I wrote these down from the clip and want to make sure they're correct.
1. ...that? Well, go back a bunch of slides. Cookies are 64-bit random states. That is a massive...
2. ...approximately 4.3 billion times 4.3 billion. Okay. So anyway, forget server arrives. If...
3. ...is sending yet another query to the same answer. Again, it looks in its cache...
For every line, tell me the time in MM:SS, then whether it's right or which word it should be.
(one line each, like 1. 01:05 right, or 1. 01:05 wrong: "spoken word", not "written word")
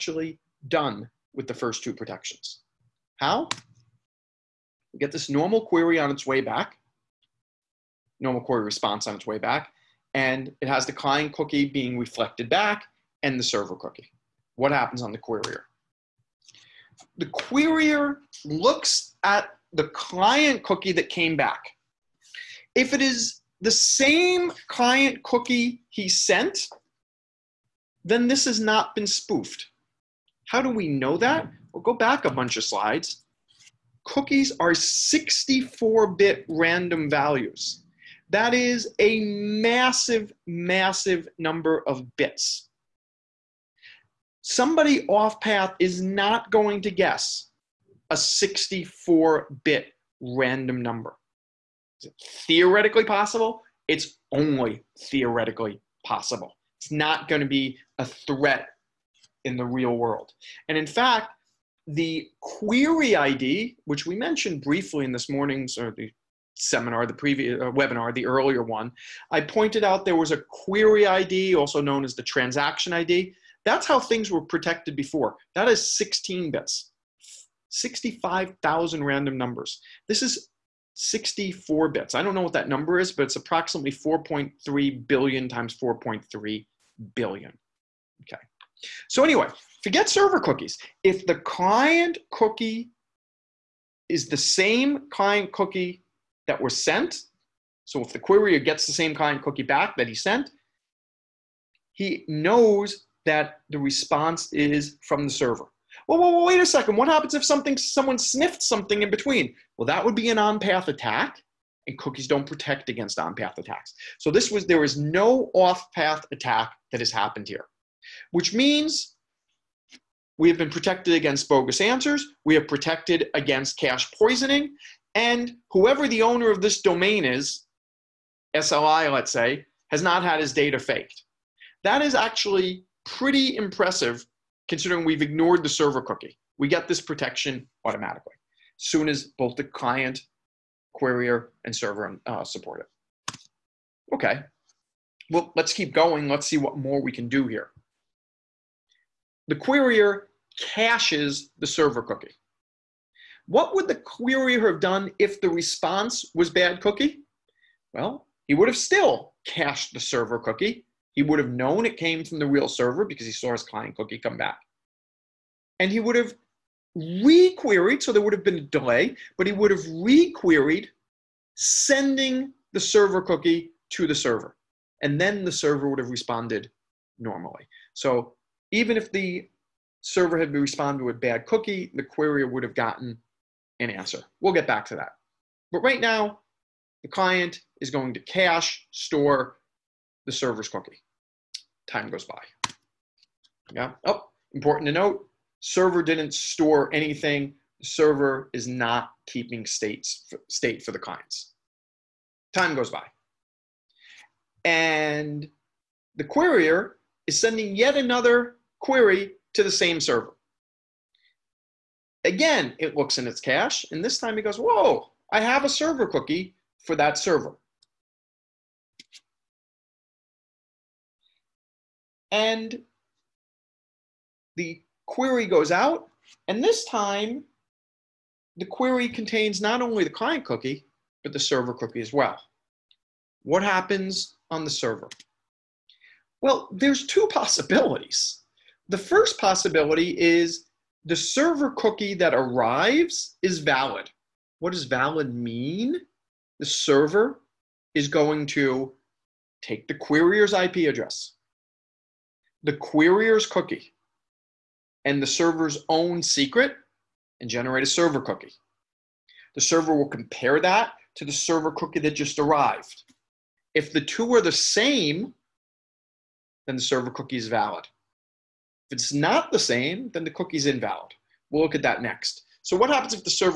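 1. 00:31 wrong: "values", not "states"
2. 01:23 wrong: "cookies", not "arrives"
3. 03:27 wrong: "server", not "answer".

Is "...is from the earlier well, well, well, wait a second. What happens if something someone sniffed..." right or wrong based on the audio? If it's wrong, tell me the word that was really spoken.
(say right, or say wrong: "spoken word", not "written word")
wrong: "server", not "earlier".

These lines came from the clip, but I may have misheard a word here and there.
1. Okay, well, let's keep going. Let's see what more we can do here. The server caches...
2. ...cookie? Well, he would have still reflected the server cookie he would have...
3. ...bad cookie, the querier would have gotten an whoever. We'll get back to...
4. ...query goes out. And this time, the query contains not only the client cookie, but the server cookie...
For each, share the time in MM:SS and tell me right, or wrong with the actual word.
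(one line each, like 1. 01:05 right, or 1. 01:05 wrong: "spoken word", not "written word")
1. 02:24 wrong: "querier", not "server"
2. 02:36 wrong: "cached", not "reflected"
3. 03:01 wrong: "answer", not "whoever"
4. 03:45 right.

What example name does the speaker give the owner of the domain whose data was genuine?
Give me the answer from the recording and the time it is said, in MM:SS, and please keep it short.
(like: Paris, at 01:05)
SLI, at 02:08.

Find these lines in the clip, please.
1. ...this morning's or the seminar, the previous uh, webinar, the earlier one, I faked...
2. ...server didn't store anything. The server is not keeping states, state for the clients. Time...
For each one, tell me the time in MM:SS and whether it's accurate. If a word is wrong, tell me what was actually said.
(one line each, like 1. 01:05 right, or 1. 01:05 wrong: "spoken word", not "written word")
1. 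01:05 wrong: "pointed", not "faked"
2. 03:15 right.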